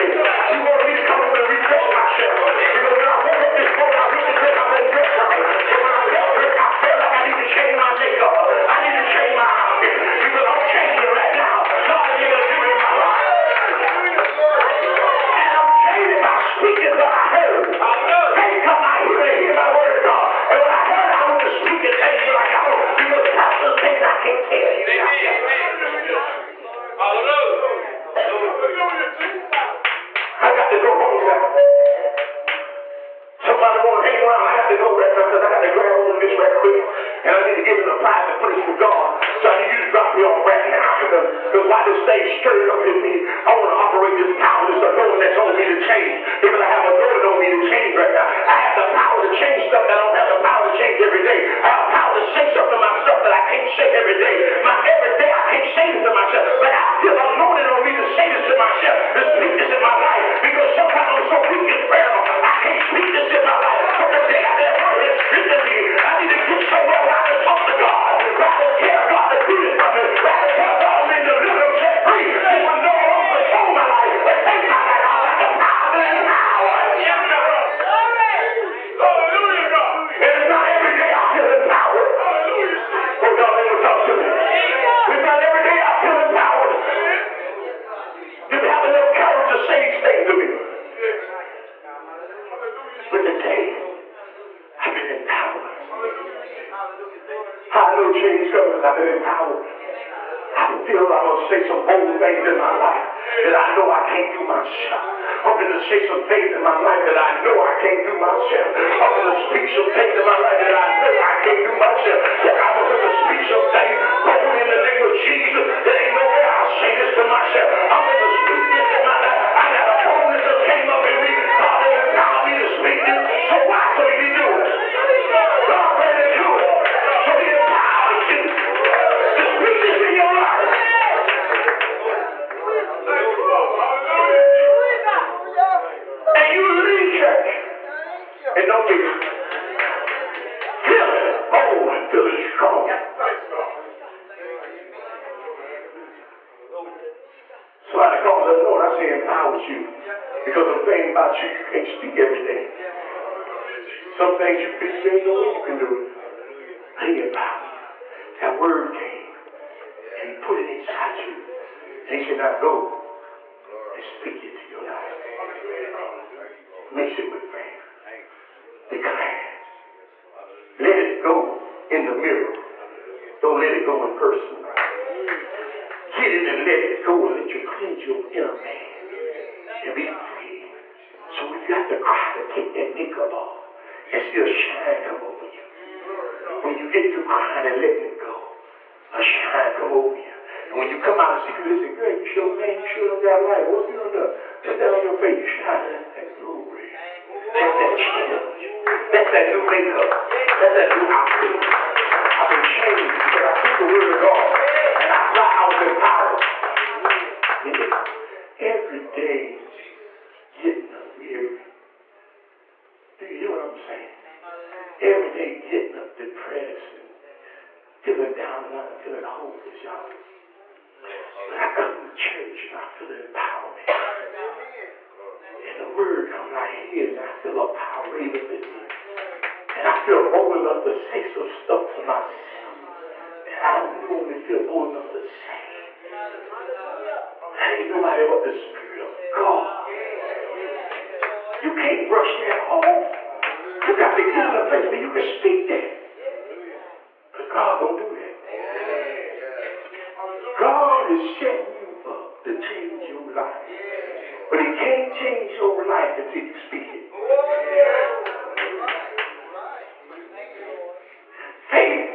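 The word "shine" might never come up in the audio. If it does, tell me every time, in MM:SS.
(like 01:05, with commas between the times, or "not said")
03:04, 03:09, 03:15.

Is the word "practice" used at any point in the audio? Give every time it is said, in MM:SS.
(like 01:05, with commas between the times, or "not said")
not said.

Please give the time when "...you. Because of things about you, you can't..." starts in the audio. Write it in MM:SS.
02:29.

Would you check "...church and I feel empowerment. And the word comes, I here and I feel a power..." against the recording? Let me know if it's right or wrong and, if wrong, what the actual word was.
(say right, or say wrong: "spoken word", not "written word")
right.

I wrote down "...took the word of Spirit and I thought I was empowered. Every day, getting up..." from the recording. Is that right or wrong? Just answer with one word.
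wrong.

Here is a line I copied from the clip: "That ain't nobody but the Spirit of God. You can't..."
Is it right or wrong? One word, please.
right.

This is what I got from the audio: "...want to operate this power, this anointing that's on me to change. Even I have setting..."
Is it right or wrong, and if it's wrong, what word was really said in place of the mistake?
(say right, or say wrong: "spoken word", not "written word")
wrong: "anointing", not "setting".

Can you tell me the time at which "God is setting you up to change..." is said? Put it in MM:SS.
04:10.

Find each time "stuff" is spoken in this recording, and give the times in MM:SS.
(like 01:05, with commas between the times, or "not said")
00:49, 03:51.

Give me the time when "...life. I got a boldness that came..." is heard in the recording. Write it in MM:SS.
01:59.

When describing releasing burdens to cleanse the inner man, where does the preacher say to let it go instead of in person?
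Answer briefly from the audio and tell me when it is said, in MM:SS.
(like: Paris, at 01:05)
Mirror, at 02:52.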